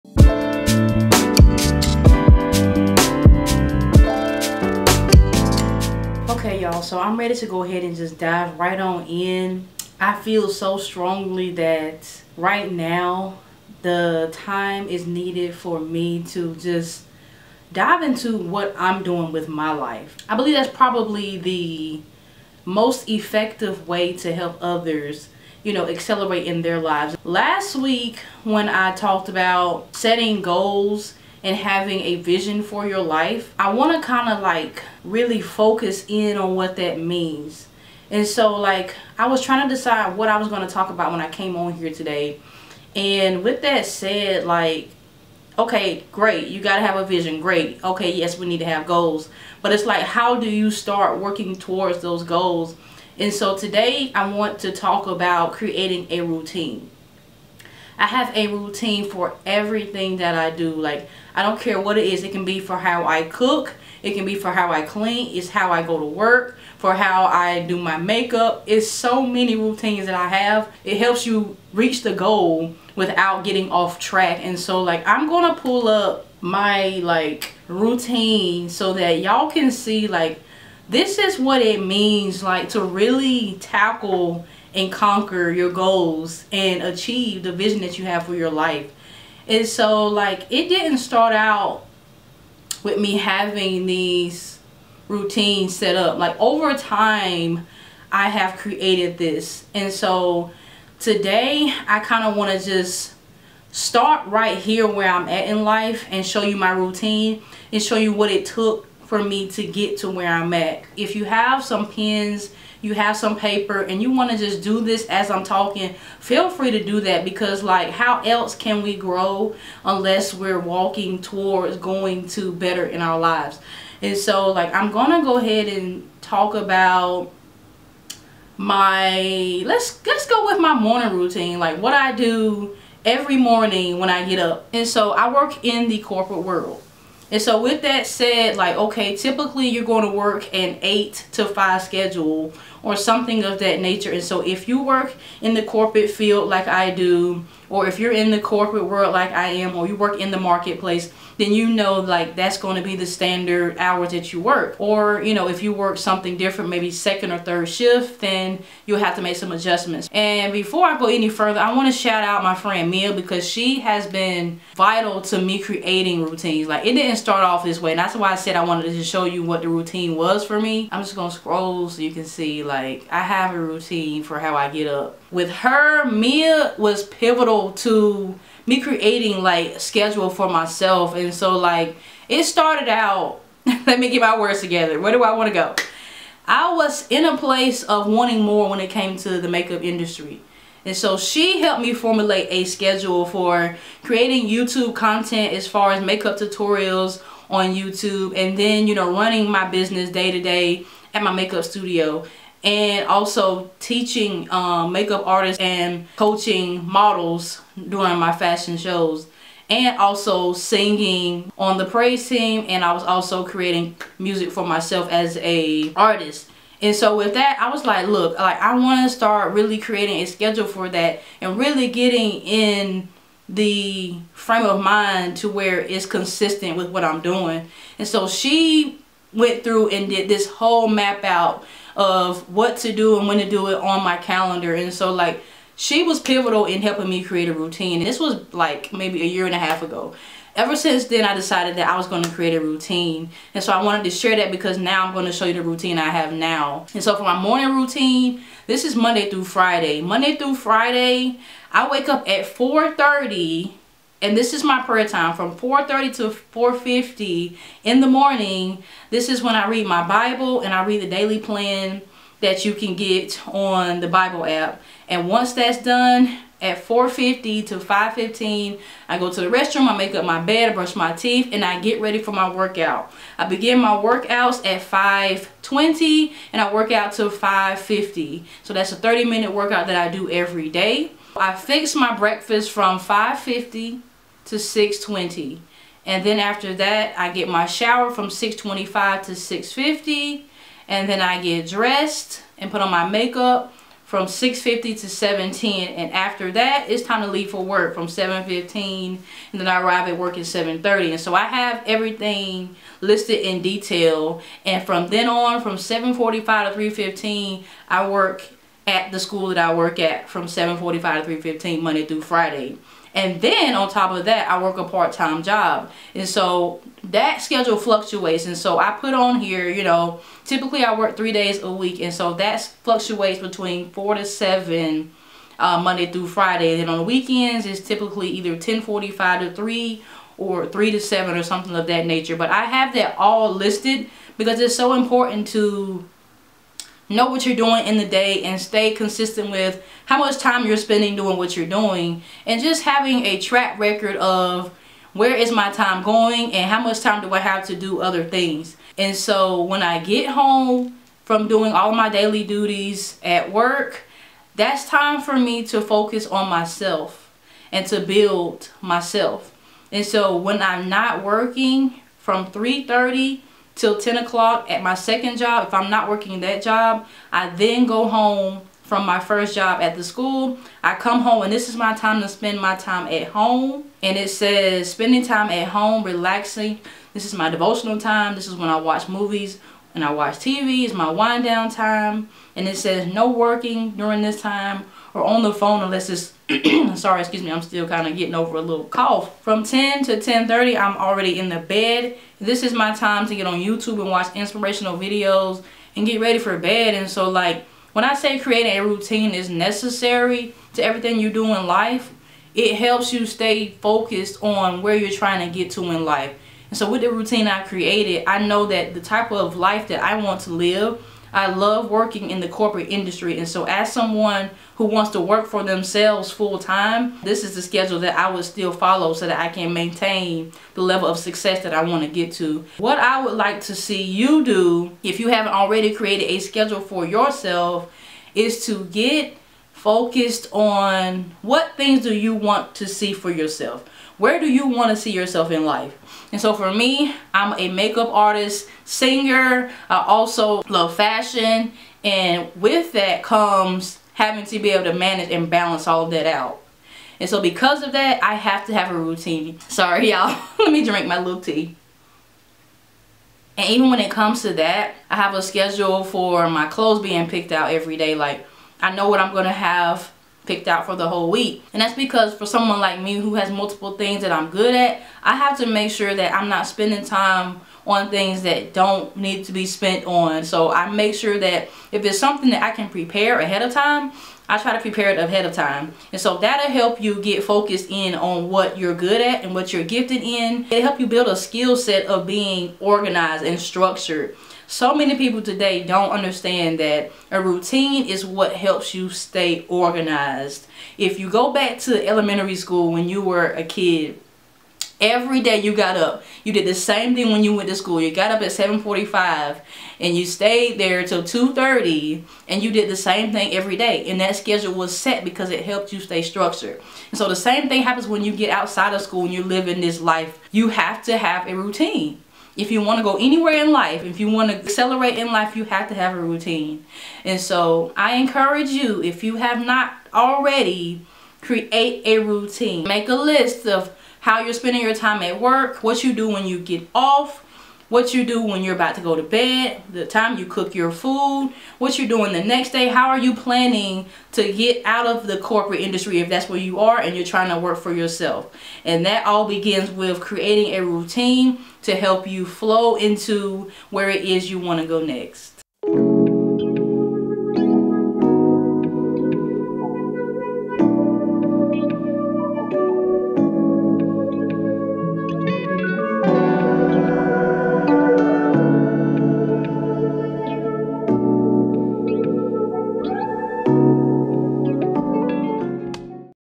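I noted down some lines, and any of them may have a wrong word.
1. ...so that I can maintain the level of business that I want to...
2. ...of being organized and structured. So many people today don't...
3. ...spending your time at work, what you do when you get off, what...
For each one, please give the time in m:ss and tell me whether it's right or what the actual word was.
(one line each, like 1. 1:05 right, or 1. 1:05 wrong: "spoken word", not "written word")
1. 6:59 wrong: "success", not "business"
2. 8:02 right
3. 8:44 right.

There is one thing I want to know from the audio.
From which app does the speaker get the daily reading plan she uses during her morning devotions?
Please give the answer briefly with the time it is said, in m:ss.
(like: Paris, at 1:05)
the Bible app, at 4:24.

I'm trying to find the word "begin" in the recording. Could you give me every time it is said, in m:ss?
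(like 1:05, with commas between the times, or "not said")
4:33, 8:59.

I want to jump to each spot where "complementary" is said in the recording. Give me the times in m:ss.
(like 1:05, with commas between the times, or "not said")
not said.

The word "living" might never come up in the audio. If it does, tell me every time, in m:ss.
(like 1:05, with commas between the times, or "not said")
8:29.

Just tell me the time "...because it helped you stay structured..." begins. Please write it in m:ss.
8:25.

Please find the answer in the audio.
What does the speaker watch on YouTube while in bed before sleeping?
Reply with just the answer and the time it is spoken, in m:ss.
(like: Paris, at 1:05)
inspirational videos, at 6:34.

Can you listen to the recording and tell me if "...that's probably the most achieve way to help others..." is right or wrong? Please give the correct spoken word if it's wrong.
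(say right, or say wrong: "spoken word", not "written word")
wrong: "effective", not "achieve".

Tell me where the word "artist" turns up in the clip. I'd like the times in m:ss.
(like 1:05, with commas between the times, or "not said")
3:25, 3:35, 7:18.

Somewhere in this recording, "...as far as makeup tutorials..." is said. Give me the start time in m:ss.
3:15.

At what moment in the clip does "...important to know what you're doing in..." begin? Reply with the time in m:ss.
5:34.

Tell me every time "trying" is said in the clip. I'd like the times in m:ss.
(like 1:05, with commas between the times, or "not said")
0:39, 6:45, 8:57.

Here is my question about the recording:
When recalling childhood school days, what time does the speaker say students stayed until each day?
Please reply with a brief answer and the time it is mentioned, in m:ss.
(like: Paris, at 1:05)
2:30, at 8:21.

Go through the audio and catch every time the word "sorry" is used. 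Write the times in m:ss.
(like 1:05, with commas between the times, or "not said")
6:27, 7:29.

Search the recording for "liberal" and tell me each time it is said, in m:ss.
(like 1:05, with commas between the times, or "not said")
not said.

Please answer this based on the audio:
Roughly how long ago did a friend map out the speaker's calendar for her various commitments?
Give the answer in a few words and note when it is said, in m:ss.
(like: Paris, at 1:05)
a year and a half ago, at 3:59.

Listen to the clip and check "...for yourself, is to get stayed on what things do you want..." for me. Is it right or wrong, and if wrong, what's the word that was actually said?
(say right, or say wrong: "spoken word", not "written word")
wrong: "focused", not "stayed".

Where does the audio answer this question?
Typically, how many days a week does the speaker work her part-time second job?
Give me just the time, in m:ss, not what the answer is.
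5:21.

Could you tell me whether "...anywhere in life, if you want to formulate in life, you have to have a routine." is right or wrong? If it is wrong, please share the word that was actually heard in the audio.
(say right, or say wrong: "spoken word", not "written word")
wrong: "accelerate", not "formulate".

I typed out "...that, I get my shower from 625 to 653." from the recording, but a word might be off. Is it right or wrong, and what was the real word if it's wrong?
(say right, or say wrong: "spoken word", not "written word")
wrong: "650", not "653".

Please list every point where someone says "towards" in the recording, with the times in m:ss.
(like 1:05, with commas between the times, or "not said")
0:51, 2:01.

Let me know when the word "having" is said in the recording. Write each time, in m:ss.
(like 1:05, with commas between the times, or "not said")
0:31, 1:33, 5:42, 7:24.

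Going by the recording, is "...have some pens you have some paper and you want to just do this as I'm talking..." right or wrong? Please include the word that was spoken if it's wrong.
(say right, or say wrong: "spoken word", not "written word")
right.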